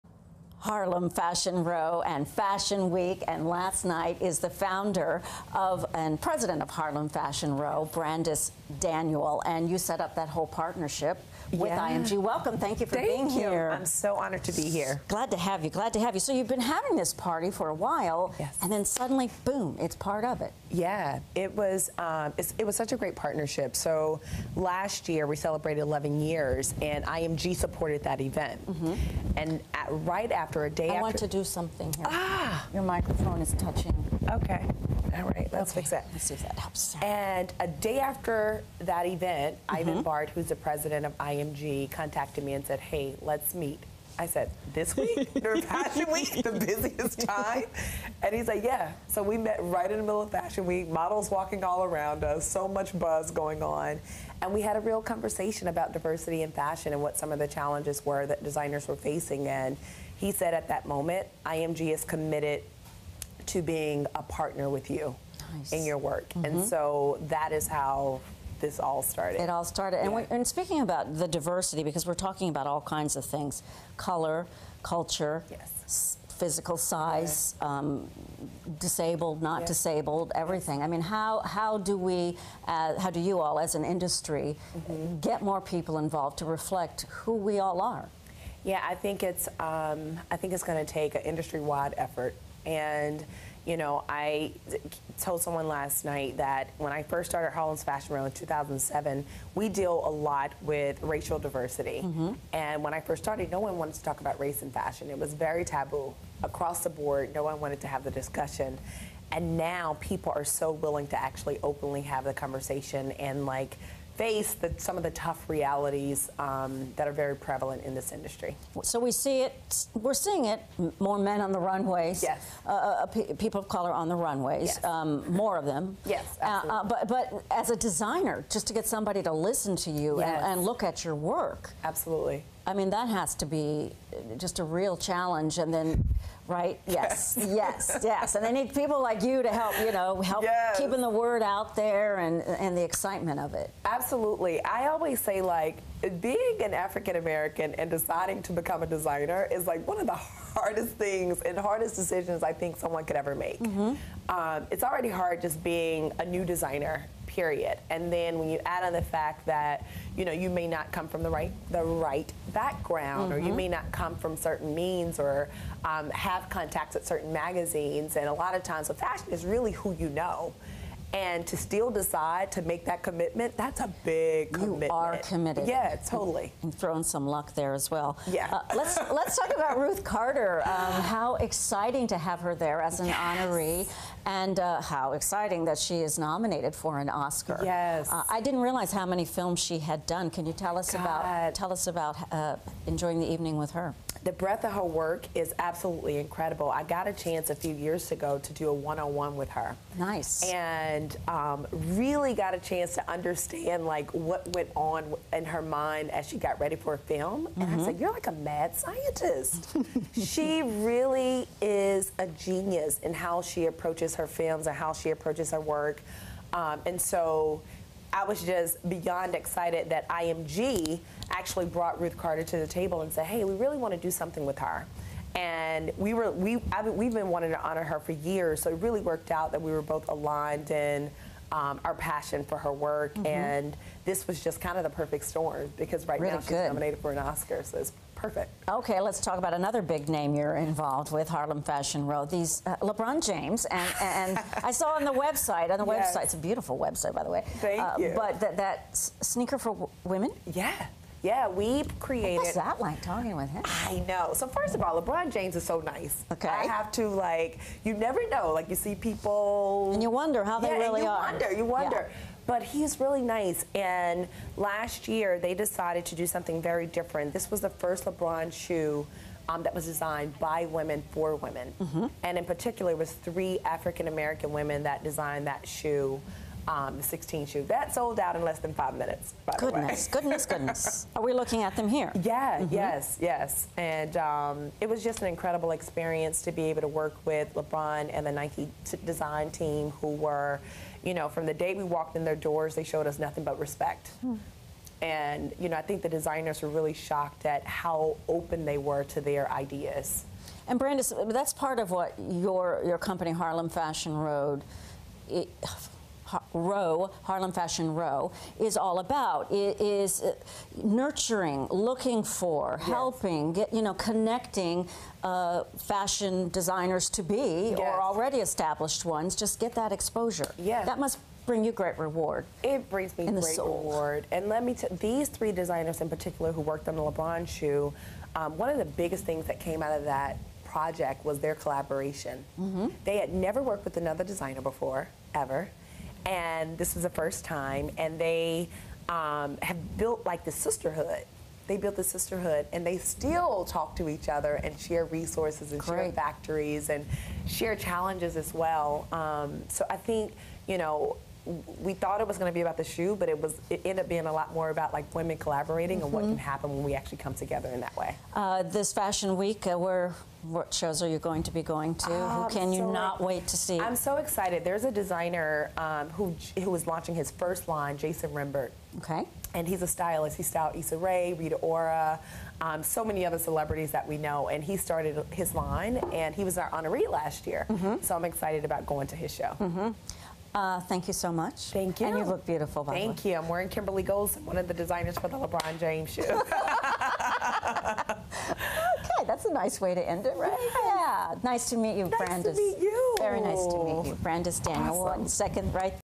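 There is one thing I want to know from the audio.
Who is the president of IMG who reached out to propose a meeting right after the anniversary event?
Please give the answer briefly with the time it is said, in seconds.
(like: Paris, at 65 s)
Ivan Bart, at 39 s.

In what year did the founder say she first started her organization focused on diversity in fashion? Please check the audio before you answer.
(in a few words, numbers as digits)
2007.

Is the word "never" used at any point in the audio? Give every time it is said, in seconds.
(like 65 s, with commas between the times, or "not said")
257 s, 333 s.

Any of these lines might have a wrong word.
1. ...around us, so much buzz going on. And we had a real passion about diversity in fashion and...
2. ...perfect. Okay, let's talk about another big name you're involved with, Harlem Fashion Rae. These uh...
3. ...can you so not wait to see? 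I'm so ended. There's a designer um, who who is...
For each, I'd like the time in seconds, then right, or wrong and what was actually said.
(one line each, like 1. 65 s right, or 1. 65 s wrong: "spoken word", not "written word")
1. 51 s wrong: "conversation", not "passion"
2. 238 s wrong: "Row", not "Rae"
3. 362 s wrong: "excited", not "ended".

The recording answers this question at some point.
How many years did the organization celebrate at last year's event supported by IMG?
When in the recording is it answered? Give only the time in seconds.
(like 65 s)
25 s.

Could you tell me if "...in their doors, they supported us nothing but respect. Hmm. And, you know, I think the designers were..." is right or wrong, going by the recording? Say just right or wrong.
wrong.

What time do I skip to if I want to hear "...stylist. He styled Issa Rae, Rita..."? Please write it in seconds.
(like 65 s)
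369 s.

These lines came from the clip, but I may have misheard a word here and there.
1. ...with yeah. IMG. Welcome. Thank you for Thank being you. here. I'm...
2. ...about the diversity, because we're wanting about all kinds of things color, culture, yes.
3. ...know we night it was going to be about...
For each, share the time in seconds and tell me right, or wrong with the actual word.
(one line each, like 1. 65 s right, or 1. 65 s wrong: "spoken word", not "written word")
1. 11 s right
2. 70 s wrong: "talking", not "wanting"
3. 350 s wrong: "thought", not "night".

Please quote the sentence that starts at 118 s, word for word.
So we see it, we're seeing it, more men on the runways, yes.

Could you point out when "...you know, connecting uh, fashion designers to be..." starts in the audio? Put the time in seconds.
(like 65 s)
313 s.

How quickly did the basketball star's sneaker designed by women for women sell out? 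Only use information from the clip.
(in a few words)
less than five minutes.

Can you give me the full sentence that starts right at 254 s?
So first of all, LeBron James is so nice.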